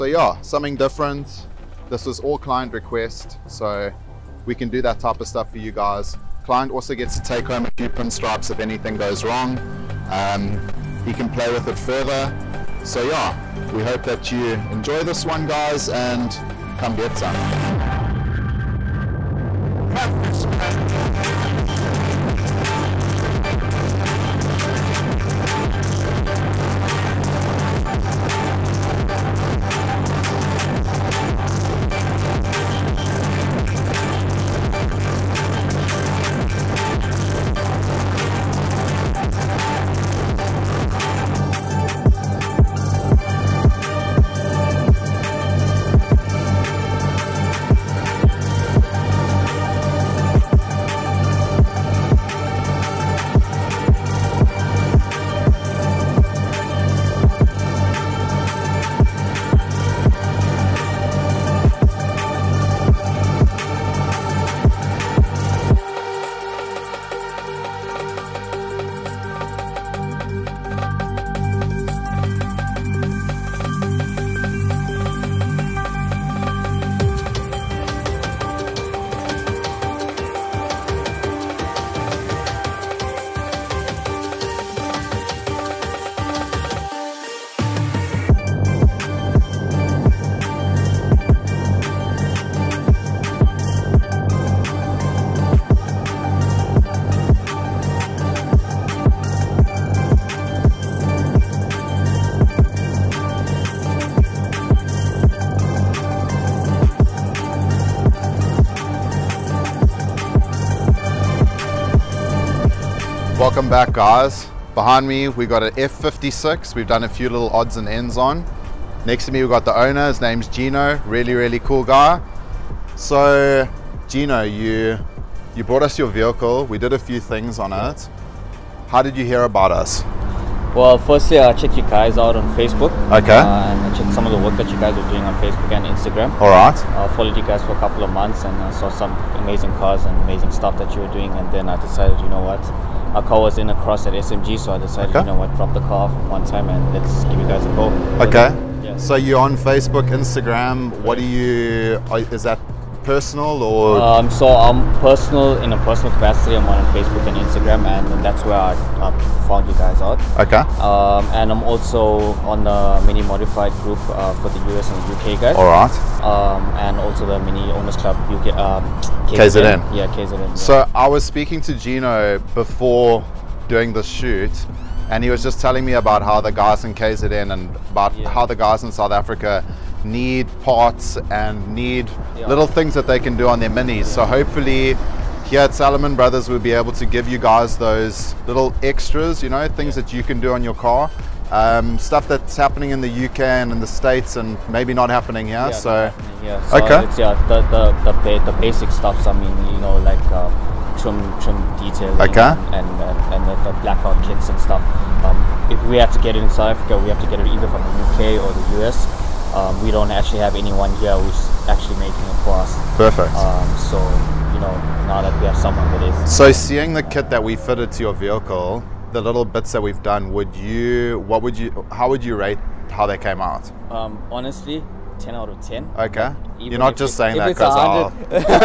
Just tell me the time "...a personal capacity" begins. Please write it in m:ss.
2:35.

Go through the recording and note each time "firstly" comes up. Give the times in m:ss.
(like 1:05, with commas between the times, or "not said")
2:10.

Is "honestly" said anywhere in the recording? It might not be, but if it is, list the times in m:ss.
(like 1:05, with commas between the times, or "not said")
3:44.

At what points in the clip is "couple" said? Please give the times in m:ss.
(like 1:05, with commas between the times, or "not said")
2:17.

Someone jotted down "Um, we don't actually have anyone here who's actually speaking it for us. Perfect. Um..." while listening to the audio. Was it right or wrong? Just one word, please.
wrong.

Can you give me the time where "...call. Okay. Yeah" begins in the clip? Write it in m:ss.
2:27.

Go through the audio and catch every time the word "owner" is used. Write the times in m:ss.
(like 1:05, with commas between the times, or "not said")
1:59, 2:47.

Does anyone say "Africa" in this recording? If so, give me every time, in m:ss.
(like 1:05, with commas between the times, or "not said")
2:59, 3:26.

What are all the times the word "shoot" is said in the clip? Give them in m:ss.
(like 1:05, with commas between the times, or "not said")
2:54.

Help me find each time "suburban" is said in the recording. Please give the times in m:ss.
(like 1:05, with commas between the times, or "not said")
not said.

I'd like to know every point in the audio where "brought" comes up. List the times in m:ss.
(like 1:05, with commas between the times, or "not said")
2:05.